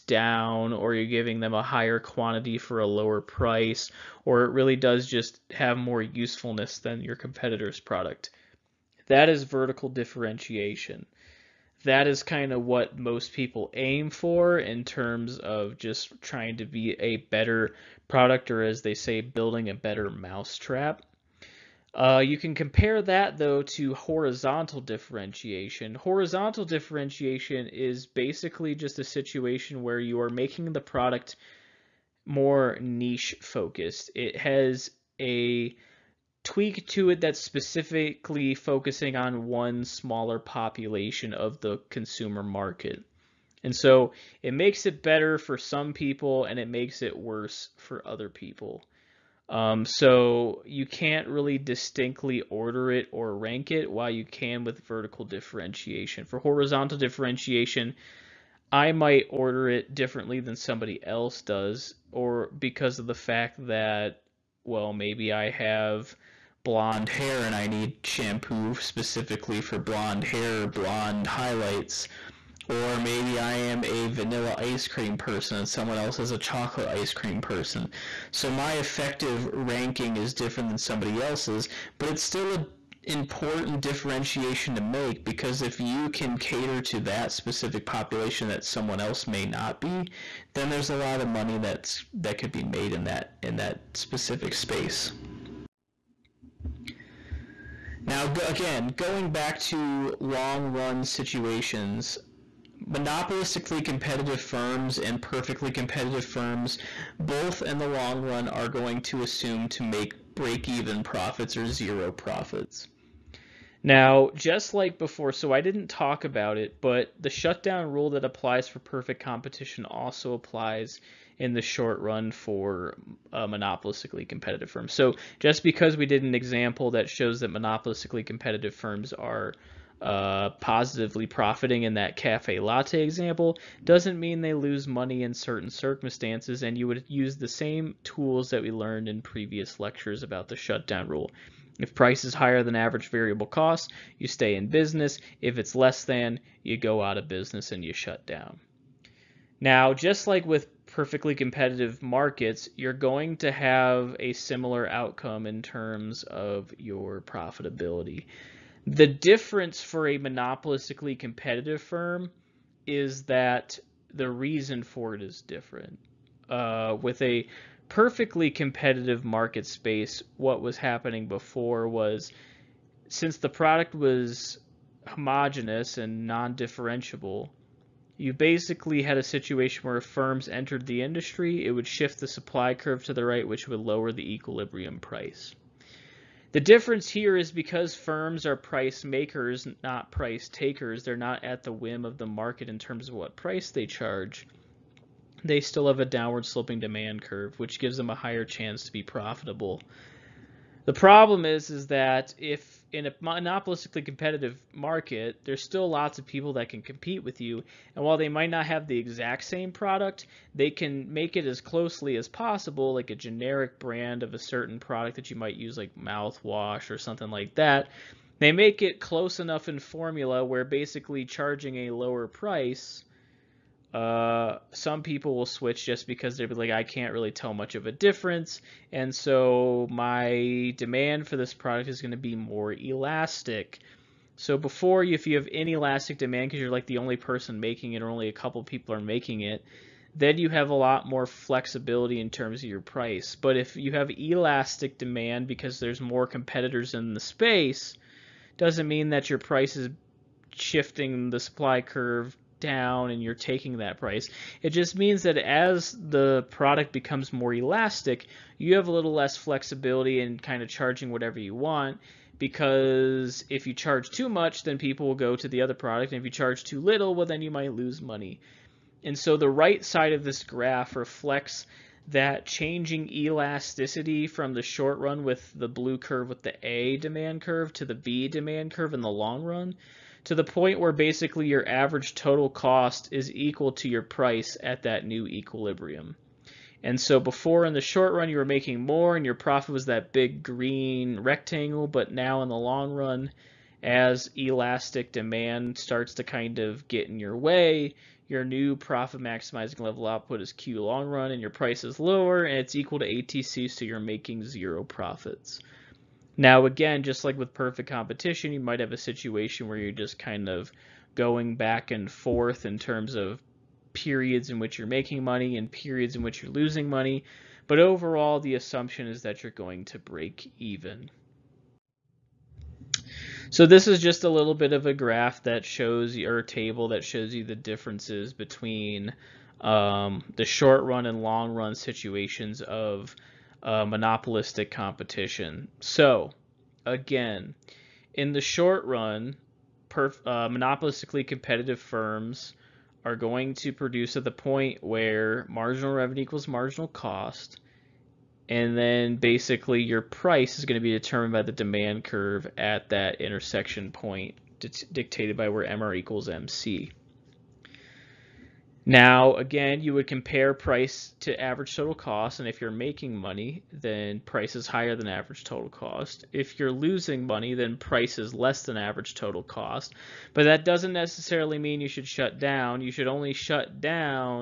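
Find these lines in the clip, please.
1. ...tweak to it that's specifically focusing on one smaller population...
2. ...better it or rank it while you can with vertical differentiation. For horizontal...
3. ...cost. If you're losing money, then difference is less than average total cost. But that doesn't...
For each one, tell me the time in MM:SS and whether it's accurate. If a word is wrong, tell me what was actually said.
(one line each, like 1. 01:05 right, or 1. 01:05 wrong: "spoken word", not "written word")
1. 00:36 right
2. 00:52 wrong: "order", not "better"
3. 06:05 wrong: "price", not "difference".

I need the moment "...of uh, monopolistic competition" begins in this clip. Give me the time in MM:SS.
05:32.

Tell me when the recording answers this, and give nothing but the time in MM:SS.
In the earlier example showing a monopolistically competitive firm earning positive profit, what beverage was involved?
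02:12.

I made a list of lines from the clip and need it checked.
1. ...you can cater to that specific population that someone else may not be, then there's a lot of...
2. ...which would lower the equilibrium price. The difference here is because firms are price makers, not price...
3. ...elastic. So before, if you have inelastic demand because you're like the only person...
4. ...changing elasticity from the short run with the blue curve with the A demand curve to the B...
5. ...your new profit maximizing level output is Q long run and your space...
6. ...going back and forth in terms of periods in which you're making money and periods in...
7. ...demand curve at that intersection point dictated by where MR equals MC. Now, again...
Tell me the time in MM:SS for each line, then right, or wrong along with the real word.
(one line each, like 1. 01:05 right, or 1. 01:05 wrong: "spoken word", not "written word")
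1. 01:25 right
2. 03:03 right
3. 03:52 right
4. 04:32 right
5. 04:58 wrong: "price", not "space"
6. 05:11 right
7. 05:51 right.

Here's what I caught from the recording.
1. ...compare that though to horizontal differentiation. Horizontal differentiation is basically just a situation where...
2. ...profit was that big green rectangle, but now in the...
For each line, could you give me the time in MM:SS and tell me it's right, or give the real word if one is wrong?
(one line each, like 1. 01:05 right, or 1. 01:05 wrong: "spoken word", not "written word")
1. 00:22 right
2. 04:49 right.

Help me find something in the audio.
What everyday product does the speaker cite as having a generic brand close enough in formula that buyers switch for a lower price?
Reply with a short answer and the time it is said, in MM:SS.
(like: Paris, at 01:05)
Mouthwash, at 03:35.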